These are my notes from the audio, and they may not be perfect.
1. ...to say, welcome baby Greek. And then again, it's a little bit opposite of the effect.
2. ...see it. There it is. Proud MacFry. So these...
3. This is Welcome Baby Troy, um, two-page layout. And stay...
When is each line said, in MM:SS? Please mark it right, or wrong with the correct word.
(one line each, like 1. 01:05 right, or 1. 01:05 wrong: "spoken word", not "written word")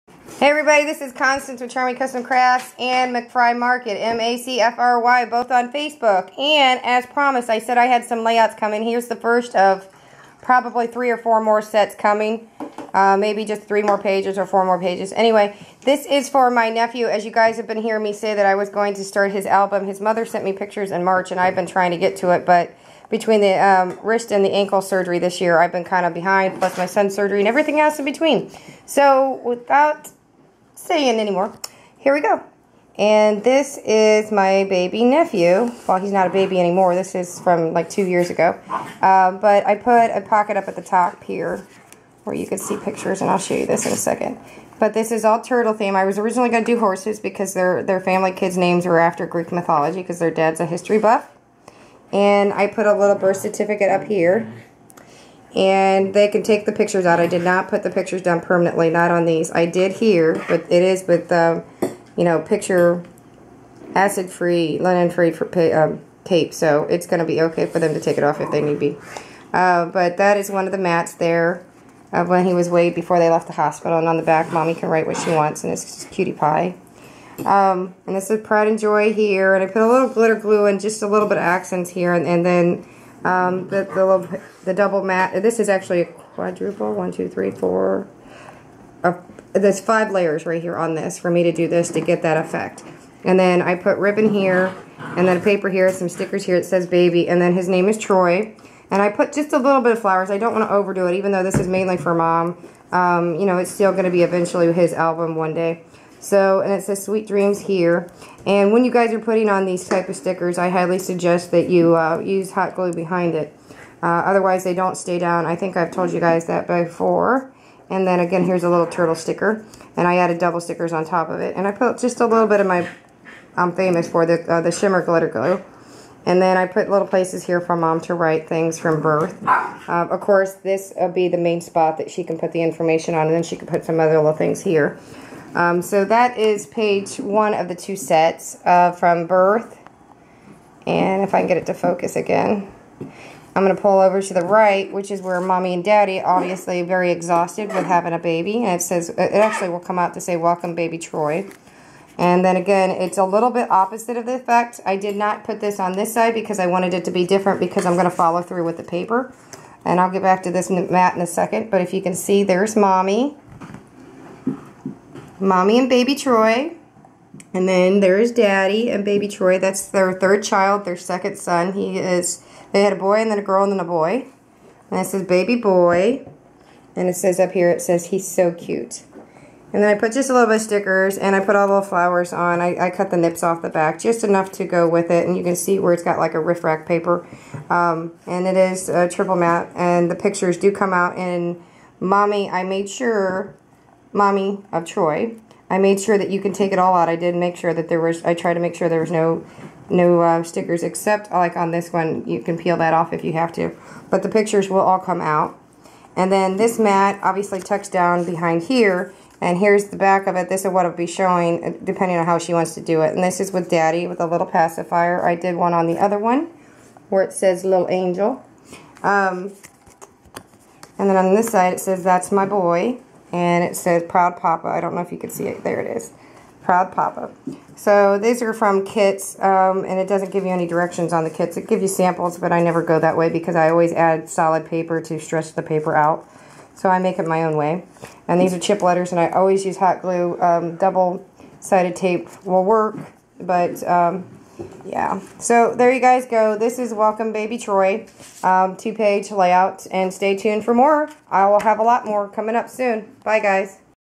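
1. 02:30 wrong: "Troy", not "Greek"
2. 03:45 wrong: "Papa", not "MacFry"
3. 04:06 right.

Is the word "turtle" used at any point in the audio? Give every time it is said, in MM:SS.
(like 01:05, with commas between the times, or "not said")
00:45, 01:58.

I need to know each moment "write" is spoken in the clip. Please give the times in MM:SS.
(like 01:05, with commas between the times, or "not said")
01:14, 02:08.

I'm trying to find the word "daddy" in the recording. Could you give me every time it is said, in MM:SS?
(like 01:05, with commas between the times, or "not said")
02:25, 02:48, 03:33.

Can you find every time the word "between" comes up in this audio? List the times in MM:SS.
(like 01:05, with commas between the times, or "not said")
00:23, 00:28.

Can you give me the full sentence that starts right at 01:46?
So, and it says sweet dreams here.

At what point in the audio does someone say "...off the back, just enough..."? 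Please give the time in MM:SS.
03:03.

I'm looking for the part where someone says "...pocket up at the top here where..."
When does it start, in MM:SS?
00:40.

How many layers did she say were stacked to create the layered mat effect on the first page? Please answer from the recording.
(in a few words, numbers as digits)
5.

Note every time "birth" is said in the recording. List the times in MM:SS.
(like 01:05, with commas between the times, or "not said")
00:53, 02:09, 02:19.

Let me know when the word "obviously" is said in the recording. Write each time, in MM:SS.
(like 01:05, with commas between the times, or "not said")
02:26, 03:27.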